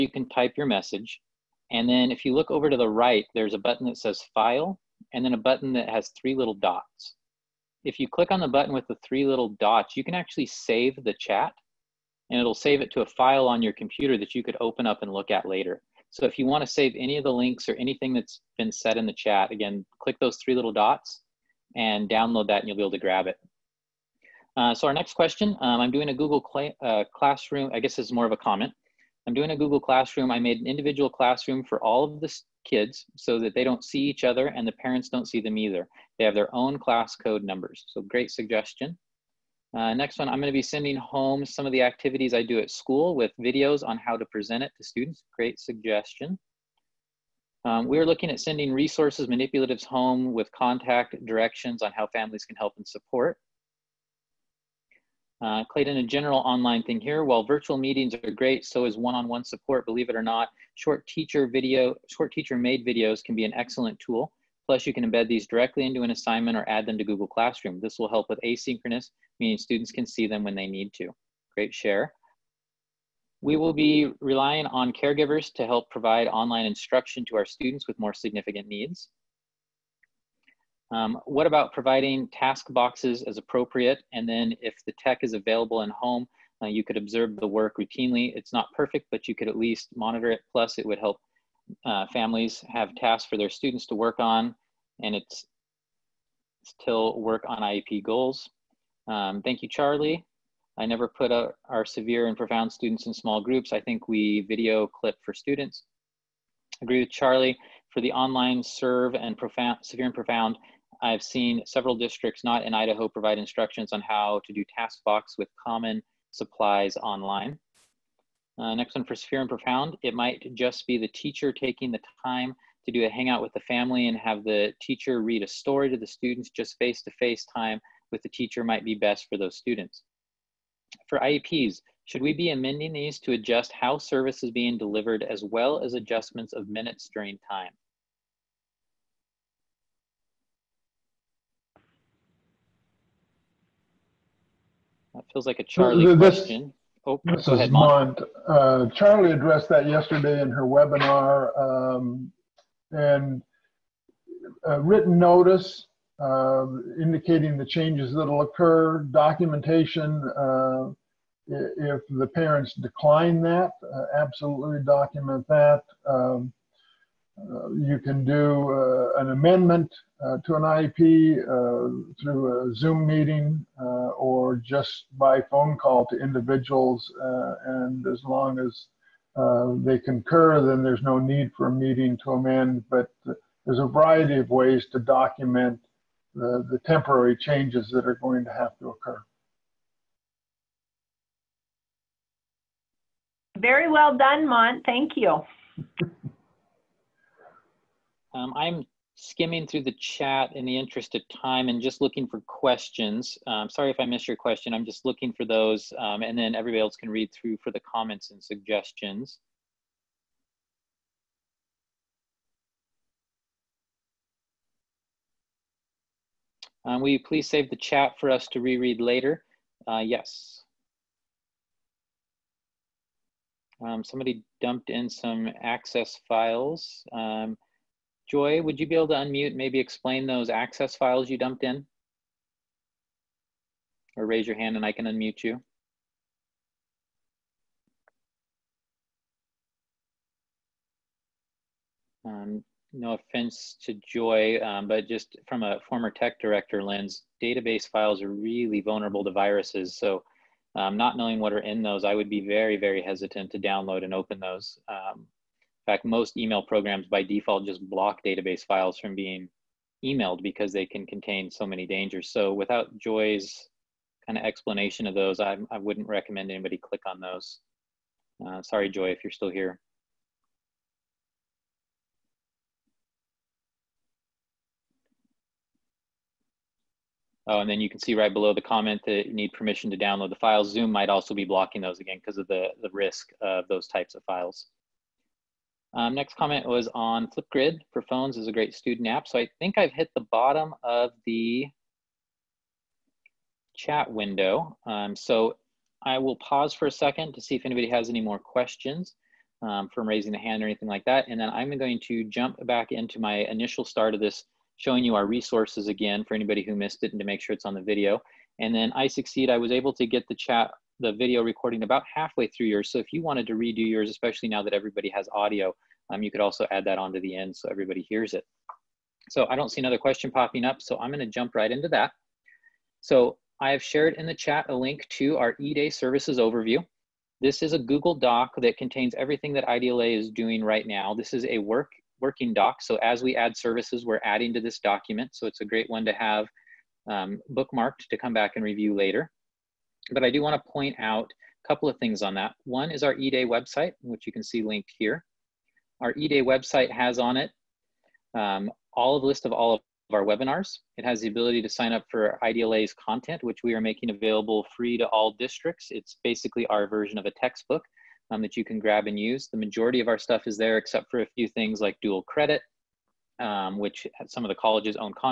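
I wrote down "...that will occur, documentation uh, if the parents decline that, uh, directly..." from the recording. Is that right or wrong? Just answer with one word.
wrong.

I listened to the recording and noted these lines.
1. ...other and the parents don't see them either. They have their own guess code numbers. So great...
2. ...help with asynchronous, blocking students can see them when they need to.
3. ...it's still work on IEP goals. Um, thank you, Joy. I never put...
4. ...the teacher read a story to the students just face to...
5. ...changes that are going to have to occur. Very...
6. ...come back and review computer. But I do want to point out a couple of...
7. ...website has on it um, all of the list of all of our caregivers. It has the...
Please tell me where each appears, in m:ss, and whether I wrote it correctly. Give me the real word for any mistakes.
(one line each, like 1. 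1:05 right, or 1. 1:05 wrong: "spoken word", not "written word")
1. 0:34 wrong: "class", not "guess"
2. 1:08 wrong: "meaning", not "blocking"
3. 1:35 wrong: "Charlie", not "Joy"
4. 2:04 right
5. 3:07 right
6. 5:38 wrong: "later", not "computer"
7. 5:46 wrong: "webinars", not "caregivers".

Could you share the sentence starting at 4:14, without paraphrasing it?
Um, fact, most email programs by default just block database files from being emailed because they can contain so many dangers.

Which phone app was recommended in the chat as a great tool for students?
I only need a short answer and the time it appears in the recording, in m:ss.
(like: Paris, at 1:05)
Flipgrid, at 4:47.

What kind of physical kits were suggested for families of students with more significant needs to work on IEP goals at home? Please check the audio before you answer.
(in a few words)
task boxes.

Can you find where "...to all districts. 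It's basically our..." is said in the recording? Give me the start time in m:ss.
5:54.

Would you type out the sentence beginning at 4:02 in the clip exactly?
Um, no offense to Joy, um, but just from a former tech director lens, database files are really vulnerable to viruses.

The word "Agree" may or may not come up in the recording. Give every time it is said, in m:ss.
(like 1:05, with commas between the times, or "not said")
1:46.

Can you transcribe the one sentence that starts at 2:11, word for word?
For IEPs, should we be amending these to adjust how service is being delivered as well as adjustments of minutes during time?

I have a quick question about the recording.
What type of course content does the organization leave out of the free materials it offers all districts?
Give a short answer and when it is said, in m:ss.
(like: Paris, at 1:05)
dual credit, at 6:02.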